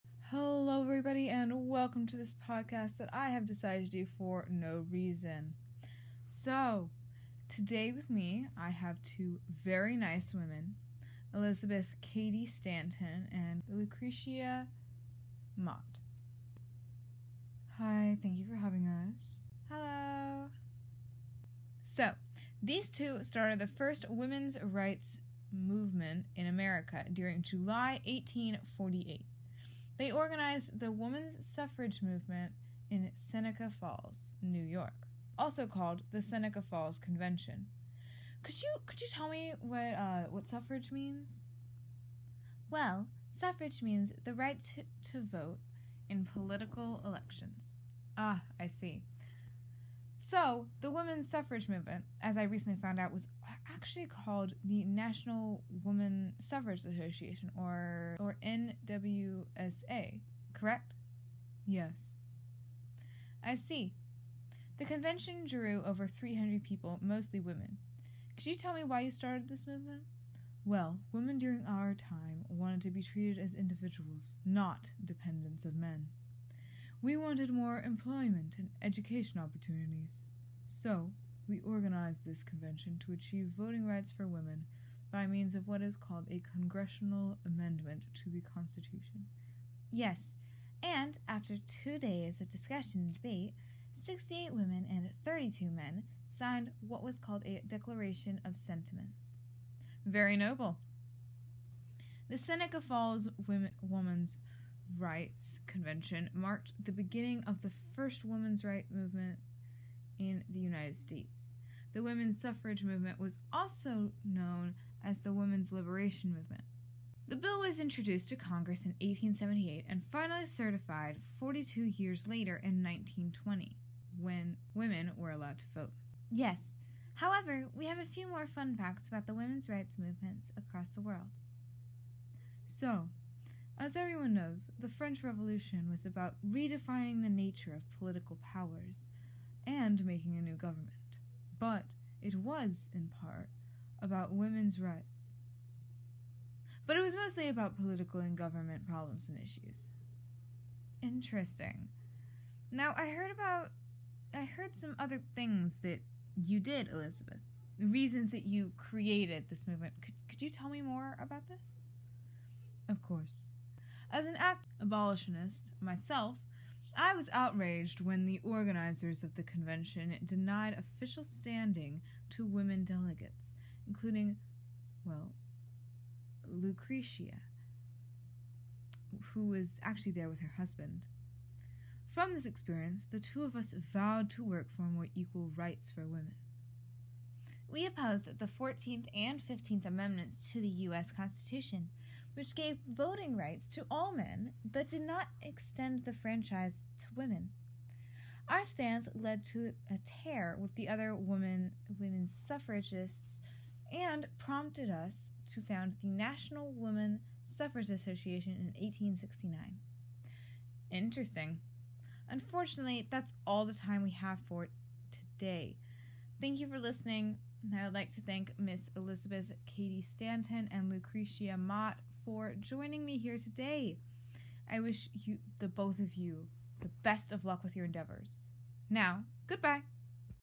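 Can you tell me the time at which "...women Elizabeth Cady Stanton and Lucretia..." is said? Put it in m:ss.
0:10.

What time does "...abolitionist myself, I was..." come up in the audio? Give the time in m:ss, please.
2:44.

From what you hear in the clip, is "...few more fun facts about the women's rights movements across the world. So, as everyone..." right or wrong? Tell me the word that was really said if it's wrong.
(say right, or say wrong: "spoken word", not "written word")
right.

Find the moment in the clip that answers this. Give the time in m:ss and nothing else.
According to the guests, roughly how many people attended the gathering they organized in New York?
1:05.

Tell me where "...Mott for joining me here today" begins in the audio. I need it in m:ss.
3:41.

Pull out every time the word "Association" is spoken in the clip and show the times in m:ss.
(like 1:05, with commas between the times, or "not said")
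0:56, 3:27.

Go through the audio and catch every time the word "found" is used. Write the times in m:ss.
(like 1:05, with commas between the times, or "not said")
0:52, 3:25.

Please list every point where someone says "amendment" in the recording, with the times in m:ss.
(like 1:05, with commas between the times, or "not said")
1:27, 3:09.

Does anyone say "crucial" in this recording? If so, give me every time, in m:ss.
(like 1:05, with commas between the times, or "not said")
not said.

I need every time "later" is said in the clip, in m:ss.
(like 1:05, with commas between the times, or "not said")
2:02.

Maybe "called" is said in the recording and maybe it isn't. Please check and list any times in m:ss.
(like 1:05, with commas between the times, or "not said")
0:35, 0:54, 1:25, 1:37.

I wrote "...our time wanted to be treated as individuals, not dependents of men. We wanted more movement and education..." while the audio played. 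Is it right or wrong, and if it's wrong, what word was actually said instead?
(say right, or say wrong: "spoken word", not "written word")
wrong: "employment", not "movement".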